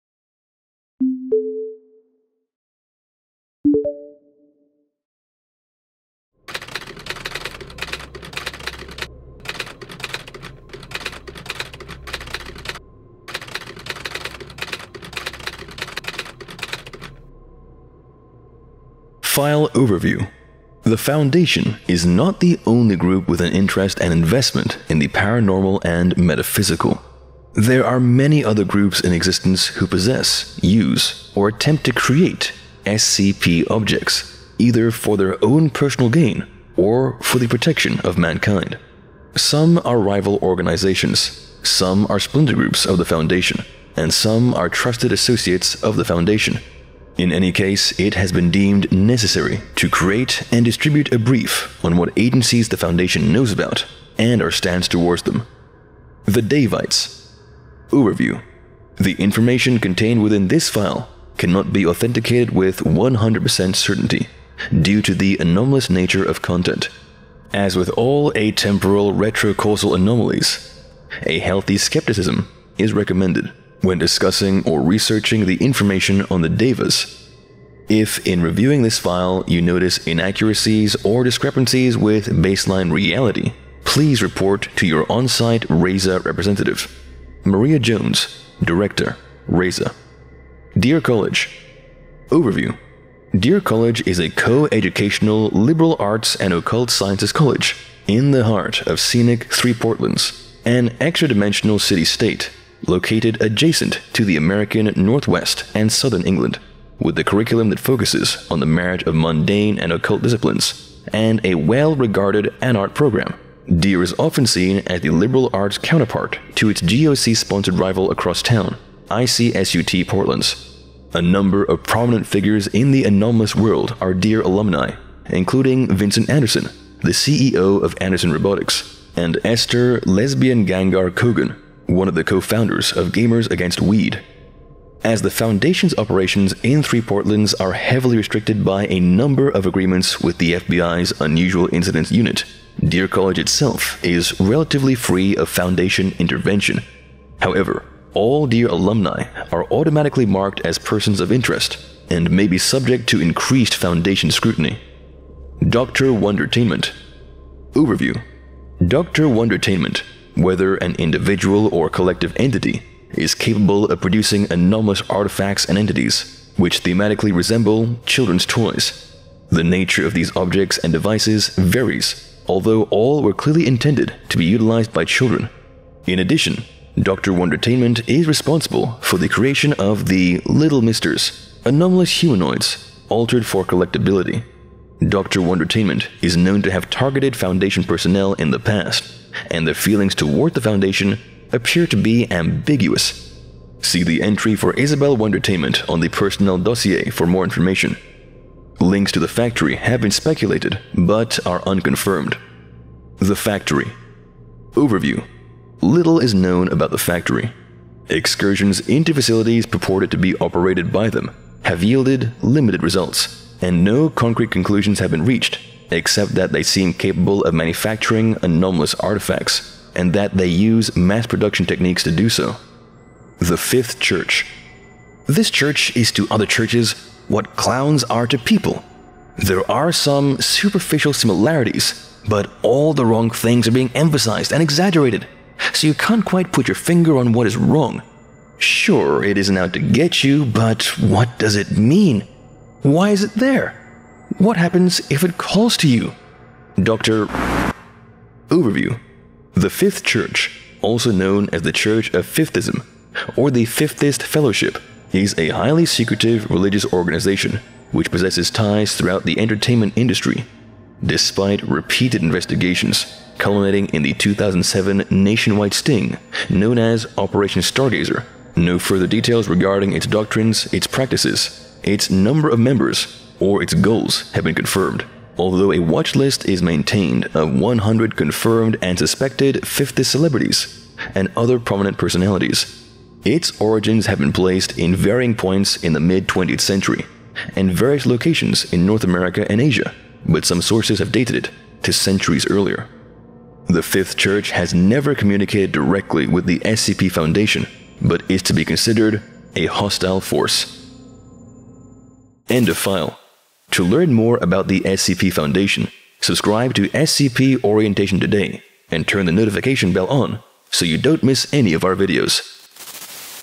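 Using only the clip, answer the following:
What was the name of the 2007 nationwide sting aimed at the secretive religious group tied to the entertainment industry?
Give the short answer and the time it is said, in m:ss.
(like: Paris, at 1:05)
Operation Stargazer, at 4:27.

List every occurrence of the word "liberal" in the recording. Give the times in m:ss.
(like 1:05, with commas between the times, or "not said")
1:35, 1:55.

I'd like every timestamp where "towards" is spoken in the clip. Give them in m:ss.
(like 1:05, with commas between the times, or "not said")
0:54, 3:10.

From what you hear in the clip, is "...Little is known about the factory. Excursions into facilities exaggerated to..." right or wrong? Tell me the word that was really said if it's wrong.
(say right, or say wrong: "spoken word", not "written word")
wrong: "purported", not "exaggerated".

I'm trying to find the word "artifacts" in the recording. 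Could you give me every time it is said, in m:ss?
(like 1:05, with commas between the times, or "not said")
2:45, 3:38.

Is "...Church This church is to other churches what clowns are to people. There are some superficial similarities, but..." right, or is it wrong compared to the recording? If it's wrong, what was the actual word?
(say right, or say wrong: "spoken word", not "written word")
right.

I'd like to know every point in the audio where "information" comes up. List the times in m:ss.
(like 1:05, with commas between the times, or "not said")
0:59, 1:15, 3:17.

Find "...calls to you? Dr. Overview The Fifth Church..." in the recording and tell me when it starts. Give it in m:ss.
4:05.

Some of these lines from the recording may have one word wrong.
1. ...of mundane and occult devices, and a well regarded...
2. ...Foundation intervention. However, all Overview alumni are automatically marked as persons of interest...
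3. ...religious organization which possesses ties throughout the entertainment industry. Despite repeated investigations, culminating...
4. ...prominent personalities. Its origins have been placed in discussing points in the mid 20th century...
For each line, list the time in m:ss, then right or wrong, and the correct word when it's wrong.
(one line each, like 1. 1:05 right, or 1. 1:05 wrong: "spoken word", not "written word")
1. 1:49 wrong: "disciplines", not "devices"
2. 2:25 wrong: "Deer", not "Overview"
3. 4:16 right
4. 4:41 wrong: "varying", not "discussing".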